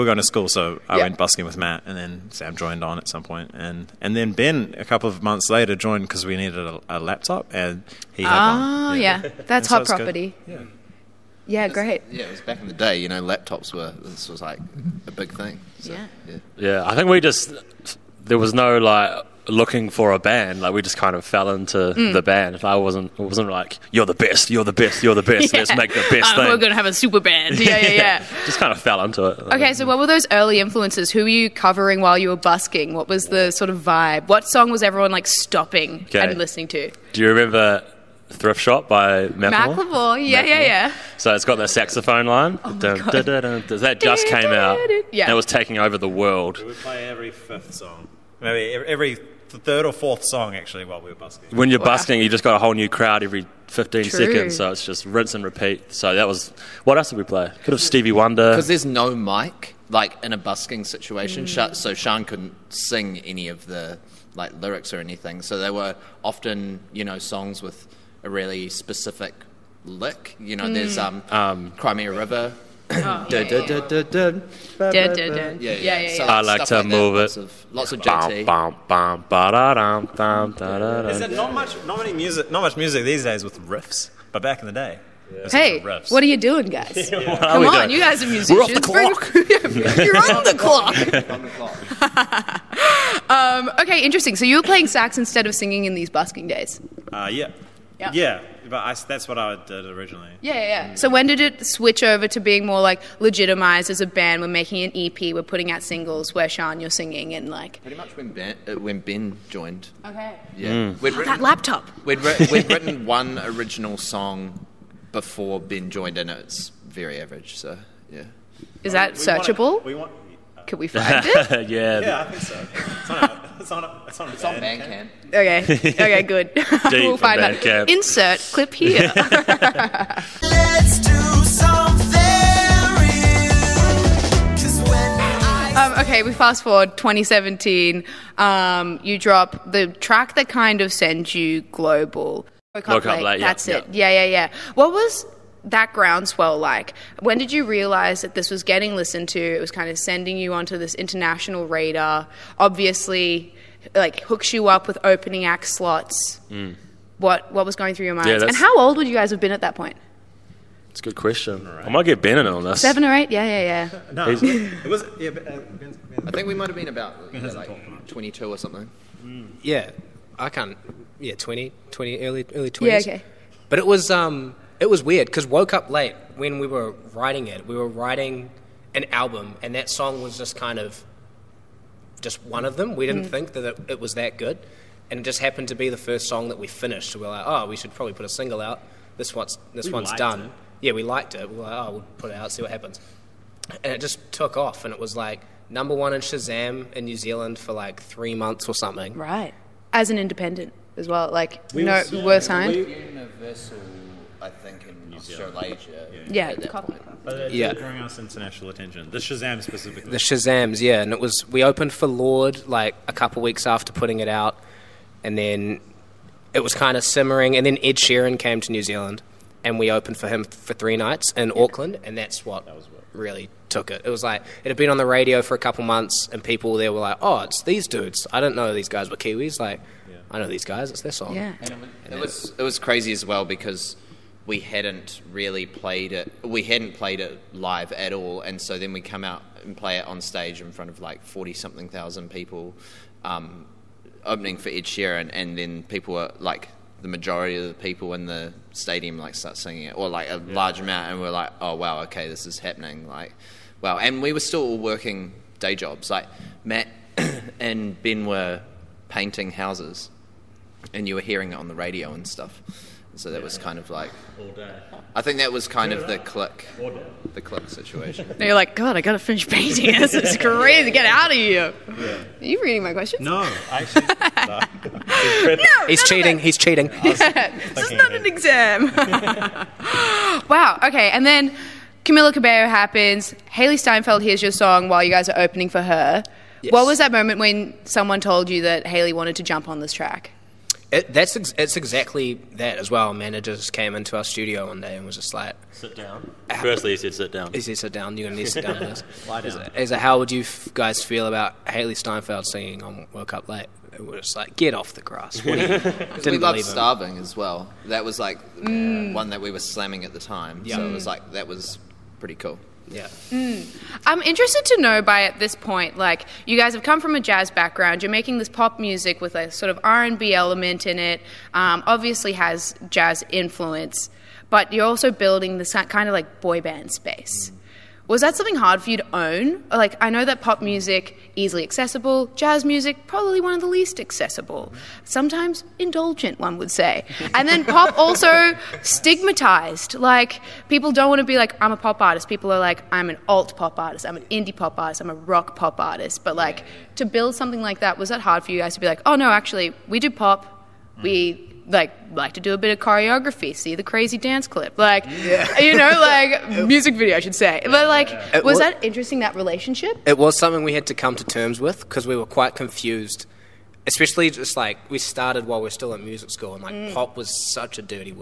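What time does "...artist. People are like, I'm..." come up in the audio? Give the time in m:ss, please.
5:42.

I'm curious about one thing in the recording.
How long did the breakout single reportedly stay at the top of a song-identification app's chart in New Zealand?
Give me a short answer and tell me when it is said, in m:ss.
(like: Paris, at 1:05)
3 months, at 3:18.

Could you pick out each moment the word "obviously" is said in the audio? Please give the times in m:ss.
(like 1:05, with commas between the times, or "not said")
2:32, 5:21.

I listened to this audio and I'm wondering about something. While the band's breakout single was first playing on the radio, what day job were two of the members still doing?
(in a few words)
painting houses.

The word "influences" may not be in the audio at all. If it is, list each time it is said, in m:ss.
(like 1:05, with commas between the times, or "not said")
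0:30, 5:23.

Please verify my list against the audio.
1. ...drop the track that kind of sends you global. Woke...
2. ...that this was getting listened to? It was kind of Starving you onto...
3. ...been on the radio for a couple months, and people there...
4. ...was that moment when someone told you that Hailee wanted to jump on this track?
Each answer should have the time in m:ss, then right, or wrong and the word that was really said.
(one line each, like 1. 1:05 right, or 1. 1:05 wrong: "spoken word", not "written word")
1. 2:19 right
2. 2:28 wrong: "sending", not "Starving"
3. 3:44 right
4. 4:46 right.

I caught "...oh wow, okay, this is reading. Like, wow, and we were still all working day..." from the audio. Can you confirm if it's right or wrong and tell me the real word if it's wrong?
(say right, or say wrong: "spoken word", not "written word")
wrong: "happening", not "reading".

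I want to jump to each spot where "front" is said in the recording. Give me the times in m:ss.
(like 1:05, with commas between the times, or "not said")
4:00.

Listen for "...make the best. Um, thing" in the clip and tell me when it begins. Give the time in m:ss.
0:25.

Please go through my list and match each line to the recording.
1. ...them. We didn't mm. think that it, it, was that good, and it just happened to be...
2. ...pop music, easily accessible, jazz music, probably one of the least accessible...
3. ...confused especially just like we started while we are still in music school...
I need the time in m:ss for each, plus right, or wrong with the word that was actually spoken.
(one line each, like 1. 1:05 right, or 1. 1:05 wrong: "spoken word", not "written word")
1. 3:02 right
2. 5:30 right
3. 6:02 right.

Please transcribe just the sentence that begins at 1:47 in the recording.
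Pretty much when Ben, uh, when ben joined.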